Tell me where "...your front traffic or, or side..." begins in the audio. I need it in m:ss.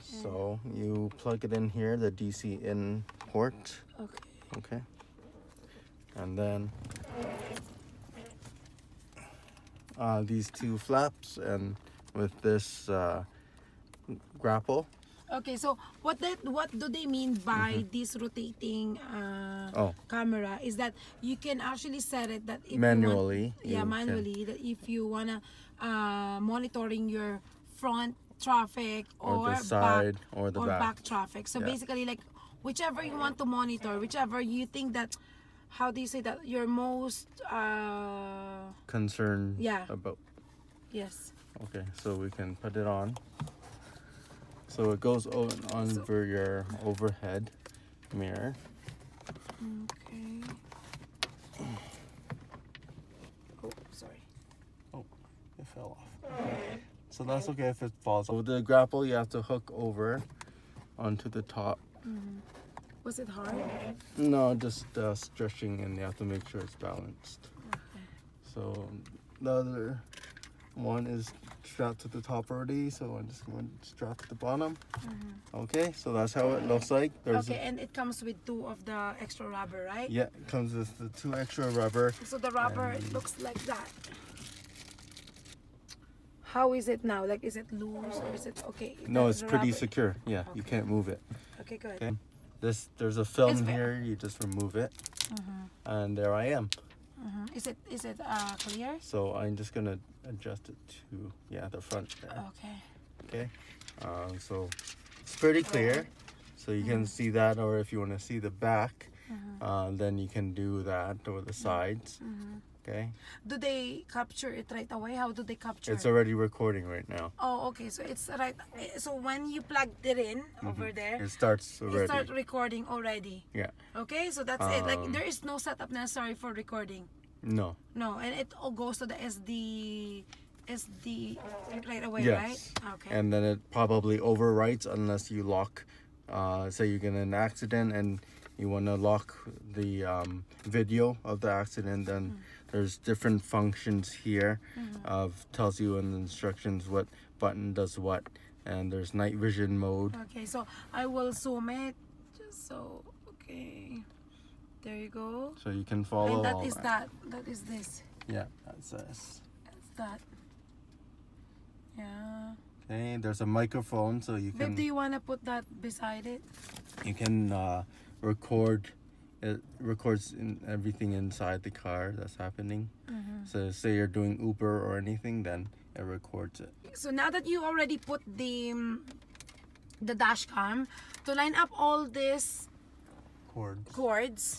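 0:27.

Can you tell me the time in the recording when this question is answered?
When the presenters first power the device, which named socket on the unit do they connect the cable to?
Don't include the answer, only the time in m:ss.
0:02.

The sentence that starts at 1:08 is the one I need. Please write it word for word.
So the other one is strapped to the top already, so I'm just going to strap to the bottom.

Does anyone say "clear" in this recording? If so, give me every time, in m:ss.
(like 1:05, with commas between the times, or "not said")
1:38, 1:45.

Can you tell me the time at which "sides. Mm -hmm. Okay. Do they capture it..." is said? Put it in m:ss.
1:51.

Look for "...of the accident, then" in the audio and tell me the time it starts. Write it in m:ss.
2:21.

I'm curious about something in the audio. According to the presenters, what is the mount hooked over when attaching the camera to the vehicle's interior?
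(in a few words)
overhead mirror.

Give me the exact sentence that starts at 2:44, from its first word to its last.
can do you want to put that beside it you can uh record it records in everything inside the car that's happening.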